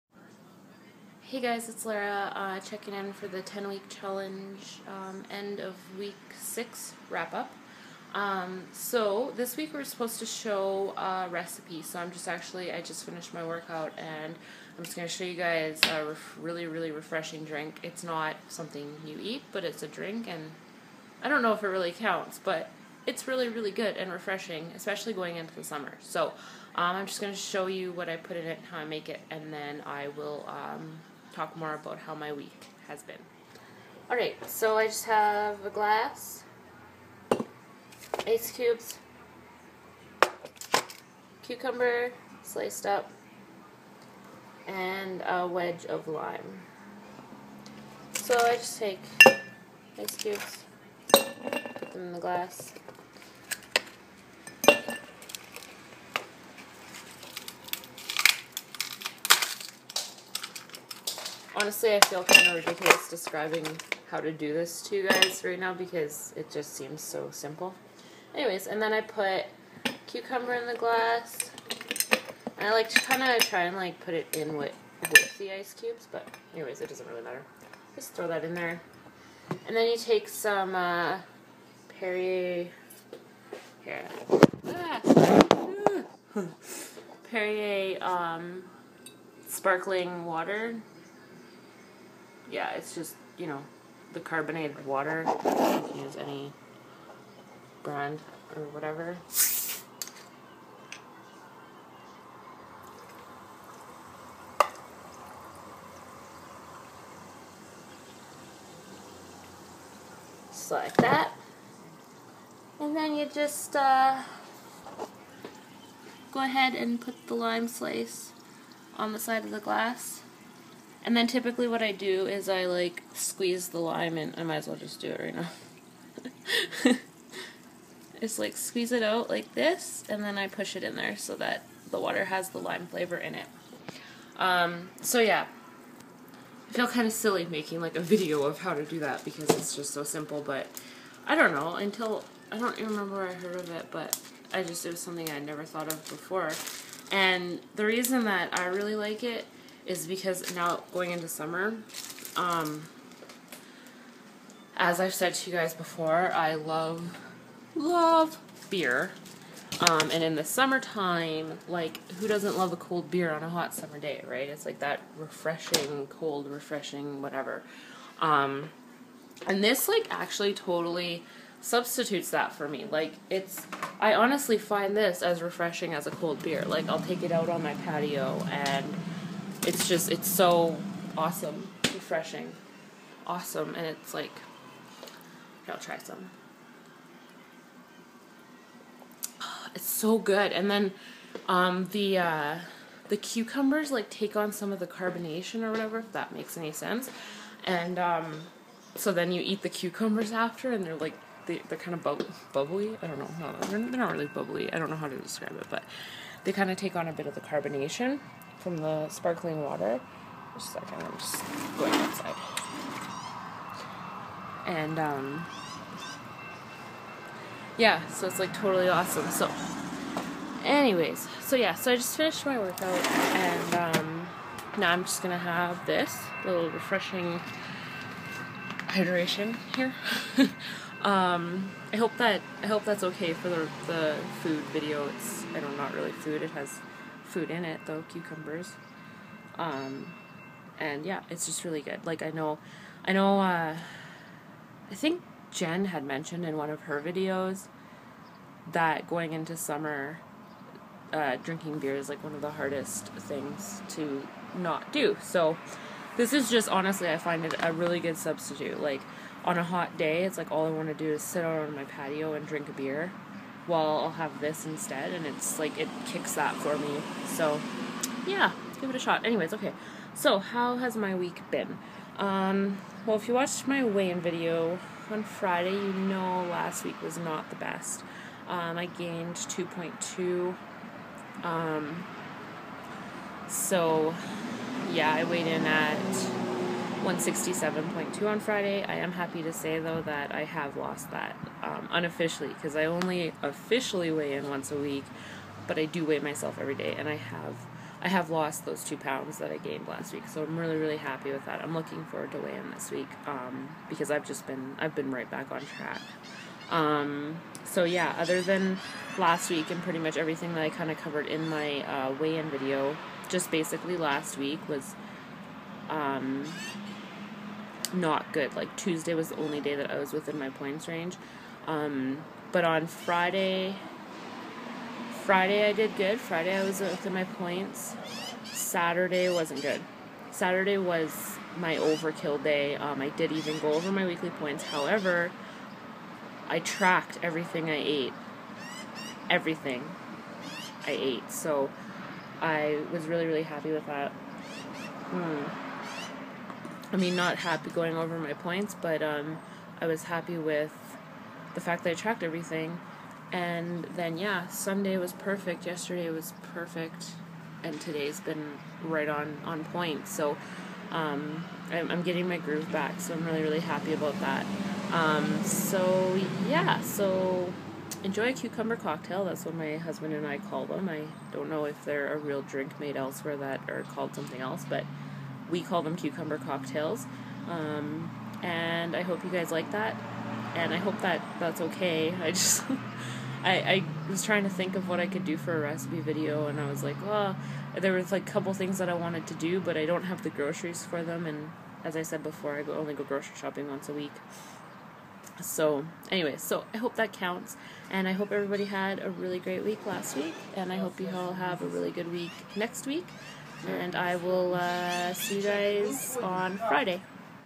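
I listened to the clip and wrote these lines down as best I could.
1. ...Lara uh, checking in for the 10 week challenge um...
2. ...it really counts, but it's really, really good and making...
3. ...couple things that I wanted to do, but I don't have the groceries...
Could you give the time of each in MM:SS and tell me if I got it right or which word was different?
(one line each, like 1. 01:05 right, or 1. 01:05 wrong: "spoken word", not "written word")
1. 00:01 right
2. 00:21 wrong: "refreshing", not "making"
3. 06:28 right.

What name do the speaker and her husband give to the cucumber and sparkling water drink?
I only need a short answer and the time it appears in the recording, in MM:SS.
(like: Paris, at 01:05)
cucumber cocktails, at 06:15.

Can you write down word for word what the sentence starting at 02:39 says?
Um, and in the summertime, like, who doesn't love a cold beer on a hot summer day, right?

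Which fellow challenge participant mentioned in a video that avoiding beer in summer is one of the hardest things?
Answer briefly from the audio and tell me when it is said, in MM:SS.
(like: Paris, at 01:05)
Jen, at 04:05.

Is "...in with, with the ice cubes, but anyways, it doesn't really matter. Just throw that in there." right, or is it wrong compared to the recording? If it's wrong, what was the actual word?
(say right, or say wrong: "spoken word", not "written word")
right.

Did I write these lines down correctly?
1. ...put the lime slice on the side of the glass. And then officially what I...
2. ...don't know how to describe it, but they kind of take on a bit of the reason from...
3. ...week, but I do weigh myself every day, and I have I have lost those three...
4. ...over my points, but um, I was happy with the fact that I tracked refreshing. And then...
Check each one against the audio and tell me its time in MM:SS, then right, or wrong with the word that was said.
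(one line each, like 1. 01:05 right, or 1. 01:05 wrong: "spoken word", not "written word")
1. 01:56 wrong: "typically", not "officially"
2. 03:24 wrong: "carbonation", not "reason"
3. 04:54 wrong: "two", not "three"
4. 05:47 wrong: "everything", not "refreshing".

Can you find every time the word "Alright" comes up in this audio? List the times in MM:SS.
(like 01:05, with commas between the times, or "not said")
00:34.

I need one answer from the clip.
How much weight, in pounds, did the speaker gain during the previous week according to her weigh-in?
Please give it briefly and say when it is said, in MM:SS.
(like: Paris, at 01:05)
2.2, at 04:39.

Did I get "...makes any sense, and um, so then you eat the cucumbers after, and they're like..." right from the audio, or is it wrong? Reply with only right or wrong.
right.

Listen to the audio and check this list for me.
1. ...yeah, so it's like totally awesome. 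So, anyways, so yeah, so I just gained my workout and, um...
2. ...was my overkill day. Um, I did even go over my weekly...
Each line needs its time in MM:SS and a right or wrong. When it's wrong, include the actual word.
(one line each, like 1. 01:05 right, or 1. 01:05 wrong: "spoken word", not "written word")
1. 03:37 wrong: "finished", not "gained"
2. 05:30 right.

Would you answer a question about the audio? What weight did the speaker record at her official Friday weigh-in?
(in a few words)
167.2.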